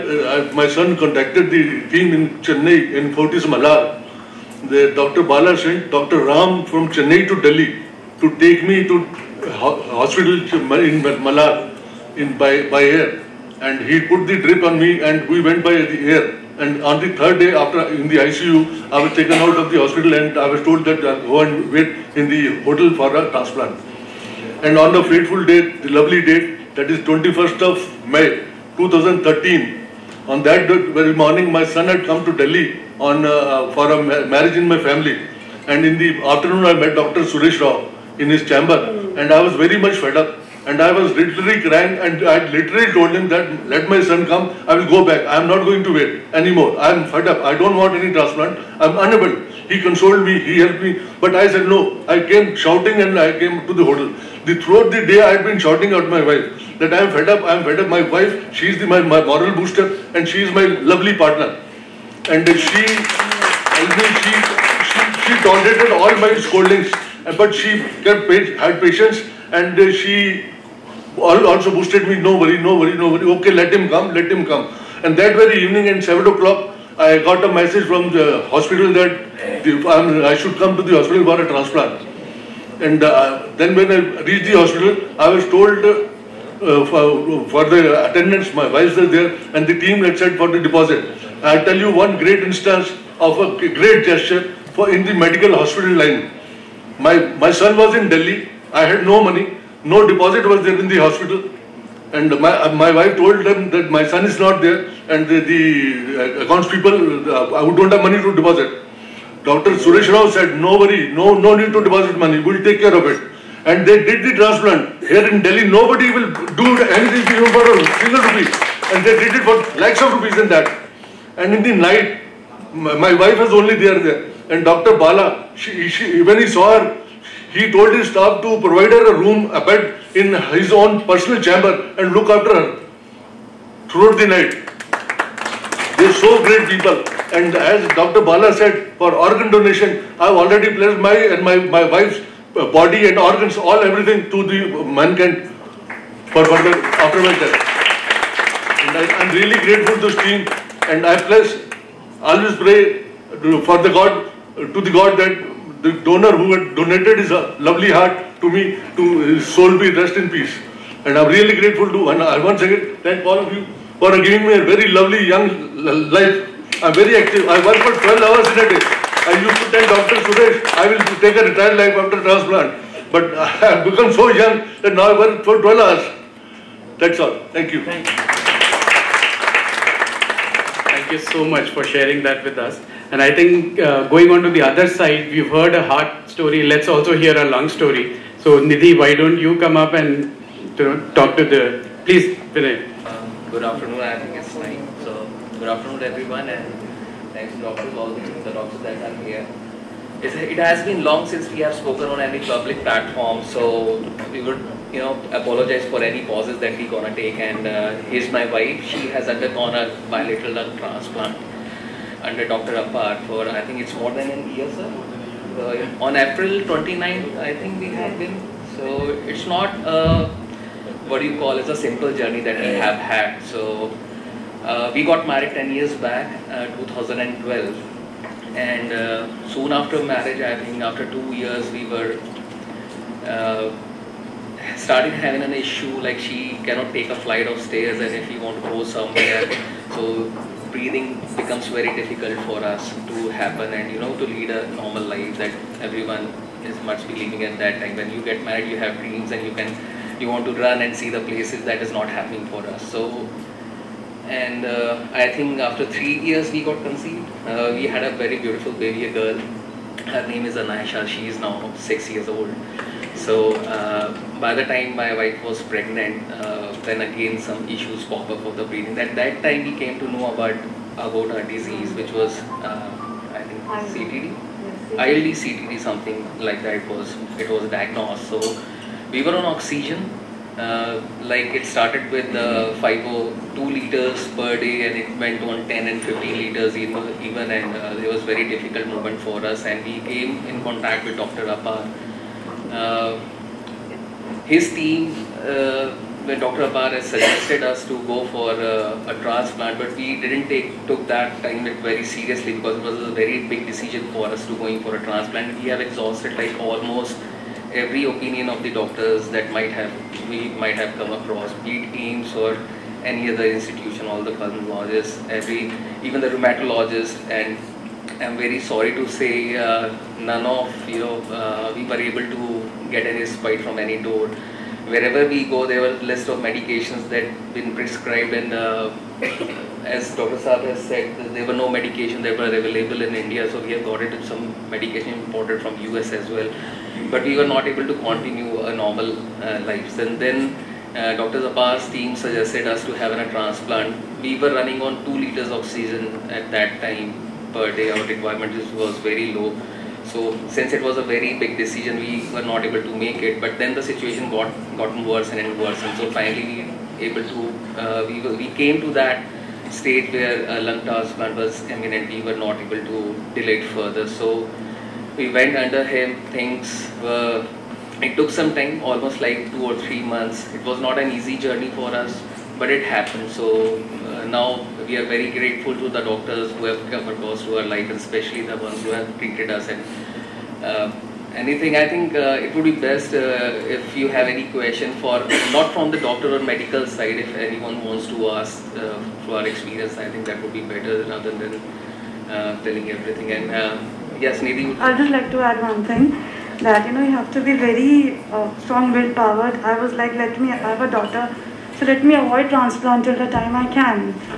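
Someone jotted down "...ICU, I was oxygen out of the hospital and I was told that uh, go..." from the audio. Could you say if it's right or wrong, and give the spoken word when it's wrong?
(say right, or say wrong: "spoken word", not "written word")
wrong: "taken", not "oxygen".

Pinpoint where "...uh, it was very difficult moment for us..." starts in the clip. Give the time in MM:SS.
04:47.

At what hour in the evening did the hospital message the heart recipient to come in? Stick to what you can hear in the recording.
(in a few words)
7 o'clock.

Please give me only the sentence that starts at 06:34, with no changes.
I'd just like to add one thing that you know you have to be very strong powered.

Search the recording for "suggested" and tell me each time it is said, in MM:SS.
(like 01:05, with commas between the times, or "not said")
04:57, 05:42.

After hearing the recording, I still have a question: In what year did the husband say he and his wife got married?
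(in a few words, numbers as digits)
2012.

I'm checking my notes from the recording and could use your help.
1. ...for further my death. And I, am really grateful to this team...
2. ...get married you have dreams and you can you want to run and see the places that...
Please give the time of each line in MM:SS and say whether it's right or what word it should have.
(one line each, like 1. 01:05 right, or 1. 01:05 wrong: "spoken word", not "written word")
1. 02:26 right
2. 04:08 right.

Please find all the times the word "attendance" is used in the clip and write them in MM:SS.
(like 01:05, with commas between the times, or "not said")
01:28.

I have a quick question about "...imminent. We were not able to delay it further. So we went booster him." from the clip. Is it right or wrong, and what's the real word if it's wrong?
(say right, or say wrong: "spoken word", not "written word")
wrong: "under", not "booster".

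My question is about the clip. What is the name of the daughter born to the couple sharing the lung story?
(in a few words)
Anasha.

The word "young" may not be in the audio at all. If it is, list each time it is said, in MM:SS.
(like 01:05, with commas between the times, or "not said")
02:45, 02:54.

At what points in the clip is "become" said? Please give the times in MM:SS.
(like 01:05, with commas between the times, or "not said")
02:53, 04:01.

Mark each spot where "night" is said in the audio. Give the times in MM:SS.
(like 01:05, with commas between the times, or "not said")
02:01, 02:14.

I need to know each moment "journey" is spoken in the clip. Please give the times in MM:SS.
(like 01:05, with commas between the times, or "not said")
03:42, 06:11.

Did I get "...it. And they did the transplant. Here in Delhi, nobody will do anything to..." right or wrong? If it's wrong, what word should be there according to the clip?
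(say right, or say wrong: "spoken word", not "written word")
right.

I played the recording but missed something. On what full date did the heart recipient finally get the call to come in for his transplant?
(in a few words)
21 May 2013.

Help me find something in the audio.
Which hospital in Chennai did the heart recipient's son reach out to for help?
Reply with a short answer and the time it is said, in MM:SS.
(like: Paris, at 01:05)
Fortis Malar, at 00:03.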